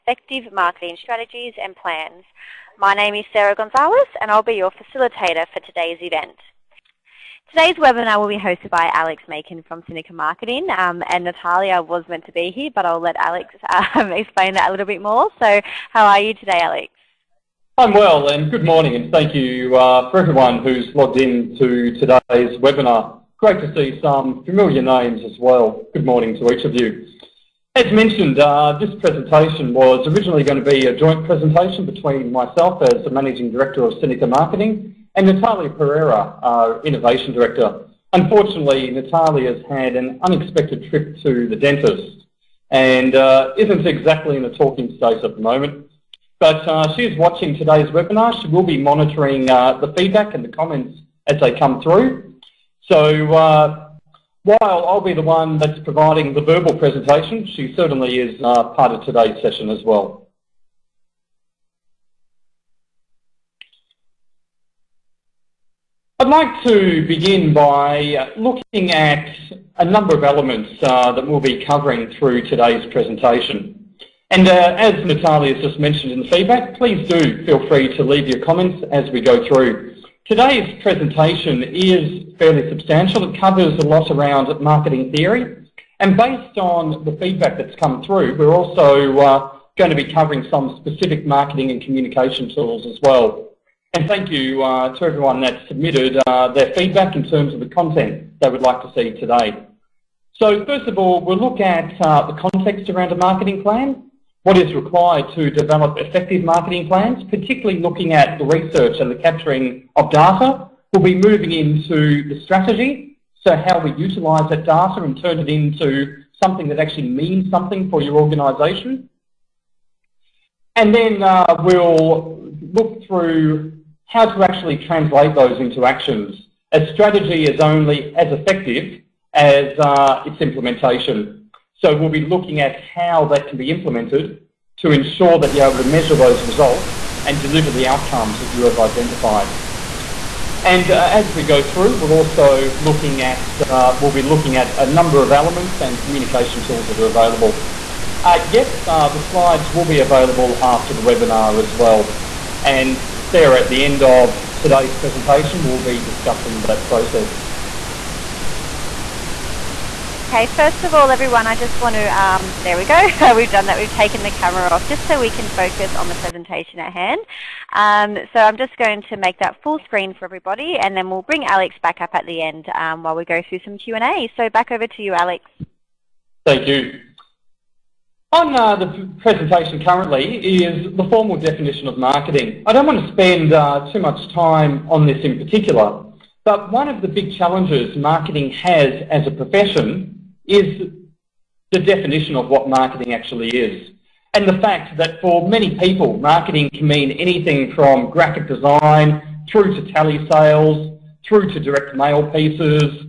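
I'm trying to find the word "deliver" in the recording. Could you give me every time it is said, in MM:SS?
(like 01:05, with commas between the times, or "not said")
02:17.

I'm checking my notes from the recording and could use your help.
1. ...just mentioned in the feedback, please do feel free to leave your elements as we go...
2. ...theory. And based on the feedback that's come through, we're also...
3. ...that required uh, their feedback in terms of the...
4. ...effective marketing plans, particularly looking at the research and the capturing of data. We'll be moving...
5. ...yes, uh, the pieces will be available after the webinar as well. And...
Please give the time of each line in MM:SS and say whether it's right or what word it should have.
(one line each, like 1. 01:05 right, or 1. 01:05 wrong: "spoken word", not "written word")
1. 01:15 wrong: "comments", not "elements"
2. 01:25 right
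3. 01:35 wrong: "submitted", not "required"
4. 01:45 right
5. 02:28 wrong: "slides", not "pieces".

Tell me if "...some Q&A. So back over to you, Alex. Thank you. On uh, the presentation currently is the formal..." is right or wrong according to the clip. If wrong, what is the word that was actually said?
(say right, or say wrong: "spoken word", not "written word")
right.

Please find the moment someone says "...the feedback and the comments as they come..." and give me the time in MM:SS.
00:49.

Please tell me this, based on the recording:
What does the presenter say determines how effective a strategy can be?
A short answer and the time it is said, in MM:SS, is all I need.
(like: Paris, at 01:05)
its implementation, at 02:10.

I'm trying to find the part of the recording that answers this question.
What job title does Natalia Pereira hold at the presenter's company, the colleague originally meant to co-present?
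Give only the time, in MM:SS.
00:36.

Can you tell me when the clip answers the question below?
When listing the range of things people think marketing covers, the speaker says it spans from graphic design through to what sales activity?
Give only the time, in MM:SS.
03:19.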